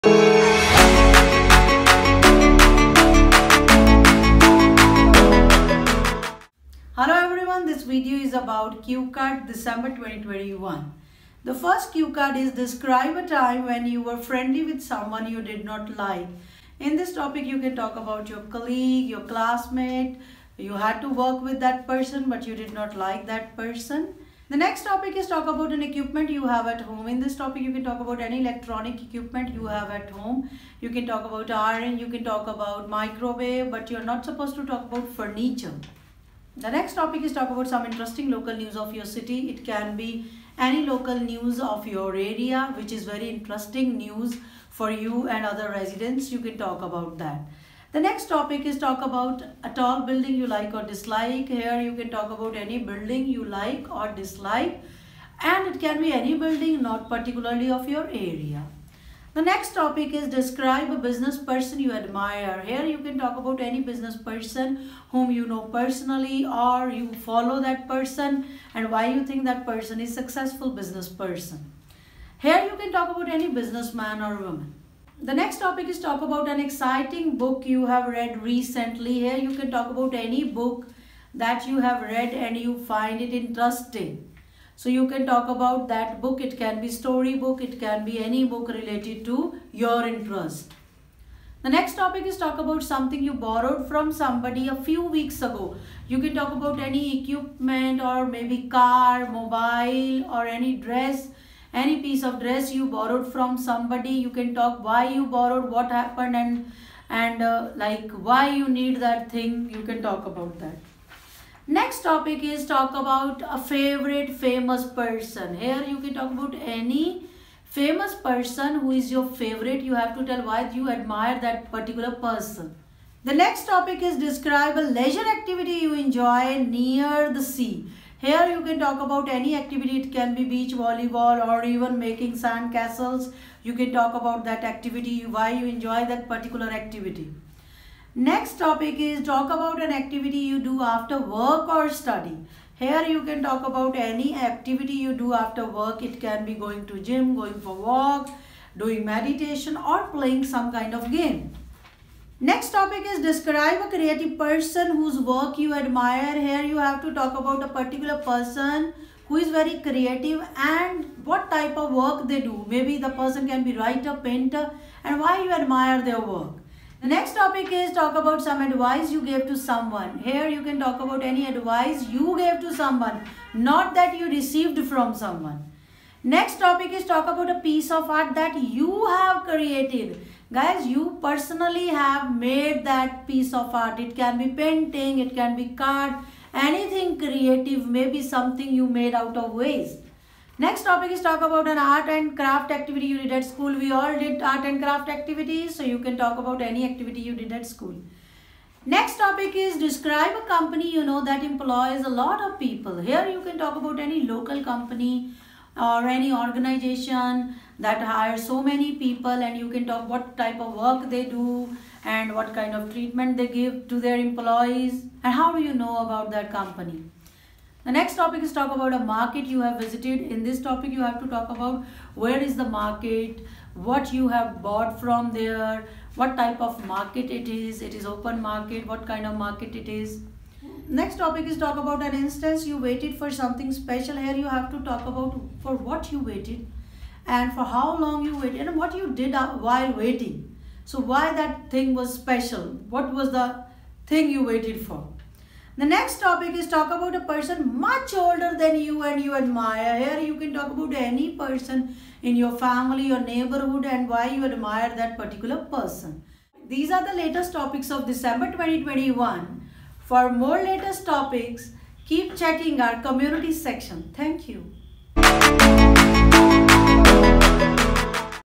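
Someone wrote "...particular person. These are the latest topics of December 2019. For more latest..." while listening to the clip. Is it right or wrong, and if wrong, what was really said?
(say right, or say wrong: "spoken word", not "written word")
wrong: "2021", not "2019".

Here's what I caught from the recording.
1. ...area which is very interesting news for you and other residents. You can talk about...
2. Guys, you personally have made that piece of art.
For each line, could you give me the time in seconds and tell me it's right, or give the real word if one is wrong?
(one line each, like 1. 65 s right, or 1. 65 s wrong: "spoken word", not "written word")
1. 42 s right
2. 180 s right.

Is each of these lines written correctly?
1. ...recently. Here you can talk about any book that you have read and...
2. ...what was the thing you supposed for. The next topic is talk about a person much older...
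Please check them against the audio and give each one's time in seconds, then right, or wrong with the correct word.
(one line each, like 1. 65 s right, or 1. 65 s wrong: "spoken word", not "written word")
1. 78 s right
2. 242 s wrong: "waited", not "supposed".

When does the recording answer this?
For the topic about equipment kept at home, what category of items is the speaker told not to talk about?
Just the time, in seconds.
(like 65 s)
35 s.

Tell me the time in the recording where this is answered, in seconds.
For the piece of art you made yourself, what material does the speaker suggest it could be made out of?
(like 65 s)
189 s.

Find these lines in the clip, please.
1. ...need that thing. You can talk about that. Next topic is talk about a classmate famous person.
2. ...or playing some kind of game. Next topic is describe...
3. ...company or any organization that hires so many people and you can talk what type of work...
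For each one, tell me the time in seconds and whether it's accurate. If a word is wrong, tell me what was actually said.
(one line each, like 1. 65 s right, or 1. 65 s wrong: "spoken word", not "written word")
1. 108 s wrong: "favorite", not "classmate"
2. 149 s right
3. 204 s right.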